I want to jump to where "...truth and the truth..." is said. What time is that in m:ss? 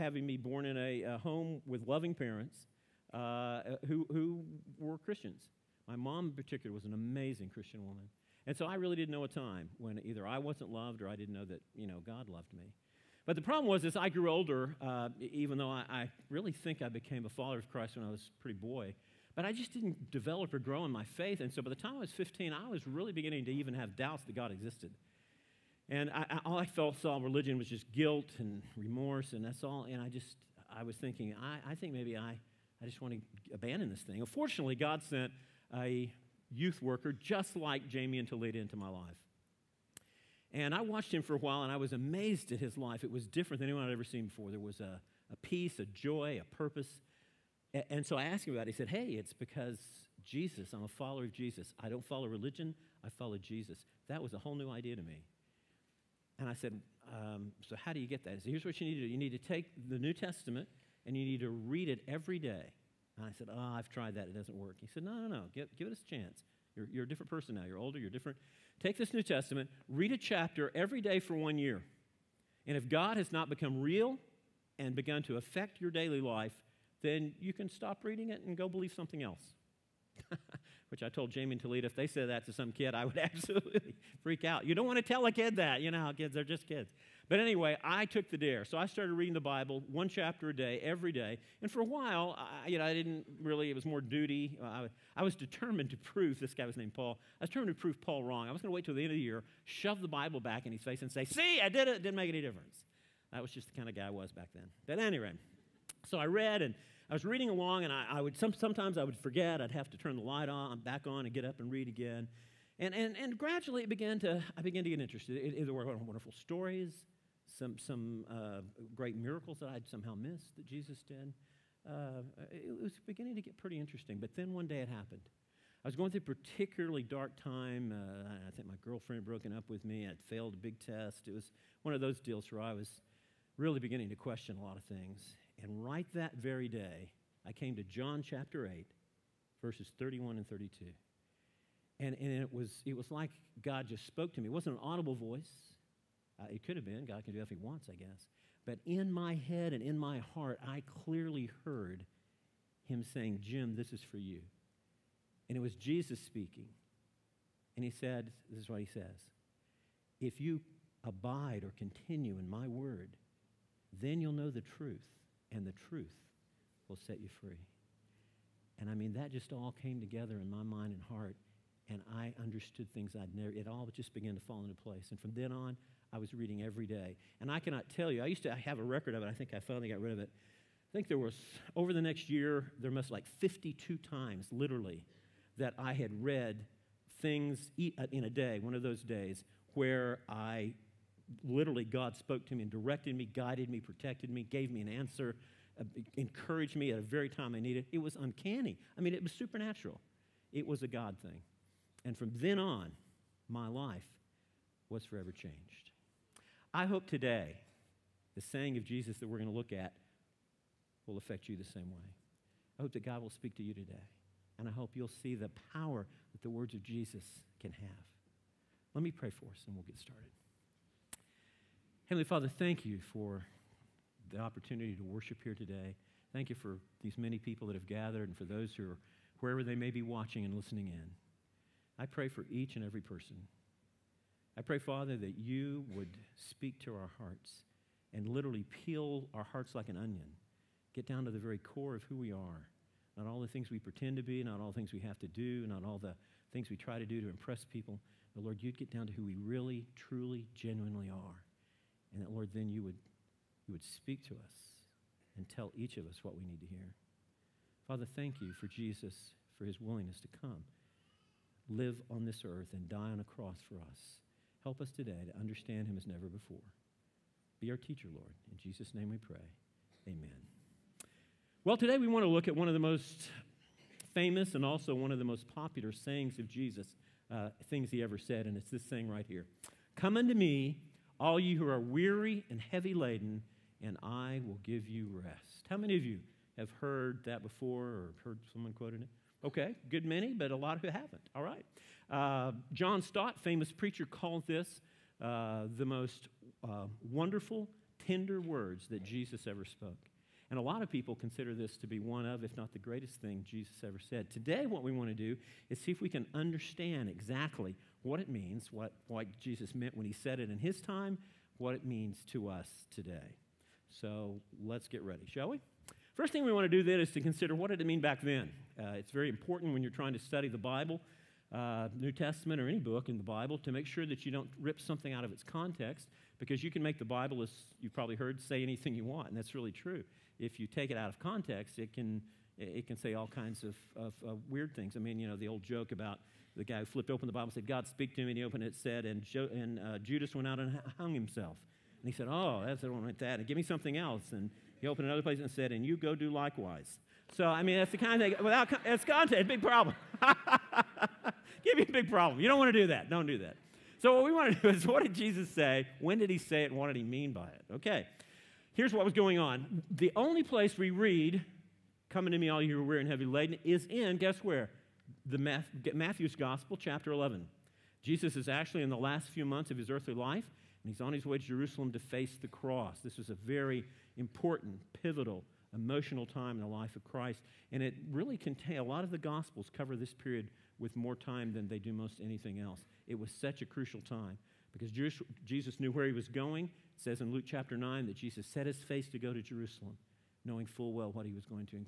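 2:44.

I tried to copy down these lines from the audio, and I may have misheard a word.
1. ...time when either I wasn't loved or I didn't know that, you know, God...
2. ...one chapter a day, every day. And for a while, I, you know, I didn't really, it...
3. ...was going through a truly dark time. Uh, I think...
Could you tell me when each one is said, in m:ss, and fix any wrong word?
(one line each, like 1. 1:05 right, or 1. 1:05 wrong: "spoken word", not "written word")
1. 0:09 right
2. 1:29 right
3. 2:05 wrong: "particularly", not "truly".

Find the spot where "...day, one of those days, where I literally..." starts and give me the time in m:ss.
3:08.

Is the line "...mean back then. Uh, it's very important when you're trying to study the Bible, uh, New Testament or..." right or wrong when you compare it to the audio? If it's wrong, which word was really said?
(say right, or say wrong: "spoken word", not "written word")
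right.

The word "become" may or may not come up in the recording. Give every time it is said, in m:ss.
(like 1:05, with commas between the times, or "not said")
1:13.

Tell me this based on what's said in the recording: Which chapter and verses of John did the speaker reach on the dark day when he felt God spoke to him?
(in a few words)
John 8:31-32.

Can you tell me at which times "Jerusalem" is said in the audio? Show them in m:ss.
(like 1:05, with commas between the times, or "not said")
6:11, 6:29.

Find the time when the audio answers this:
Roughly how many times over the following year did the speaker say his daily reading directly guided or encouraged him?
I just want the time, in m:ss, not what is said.
3:03.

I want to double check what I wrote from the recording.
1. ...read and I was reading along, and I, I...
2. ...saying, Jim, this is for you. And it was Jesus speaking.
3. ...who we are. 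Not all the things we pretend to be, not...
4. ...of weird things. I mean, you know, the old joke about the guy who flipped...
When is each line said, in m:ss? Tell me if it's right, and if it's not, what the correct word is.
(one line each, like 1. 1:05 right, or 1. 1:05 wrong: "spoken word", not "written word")
1. 1:46 right
2. 2:33 right
3. 4:02 right
4. 5:34 right.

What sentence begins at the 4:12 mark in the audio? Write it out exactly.
And that, Lord, then you would, you would speak to us and tell each of us what we need to hear.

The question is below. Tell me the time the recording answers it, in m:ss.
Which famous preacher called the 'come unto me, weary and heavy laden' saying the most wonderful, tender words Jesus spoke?
4:52.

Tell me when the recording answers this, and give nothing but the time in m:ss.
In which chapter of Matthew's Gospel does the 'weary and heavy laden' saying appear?
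6:06.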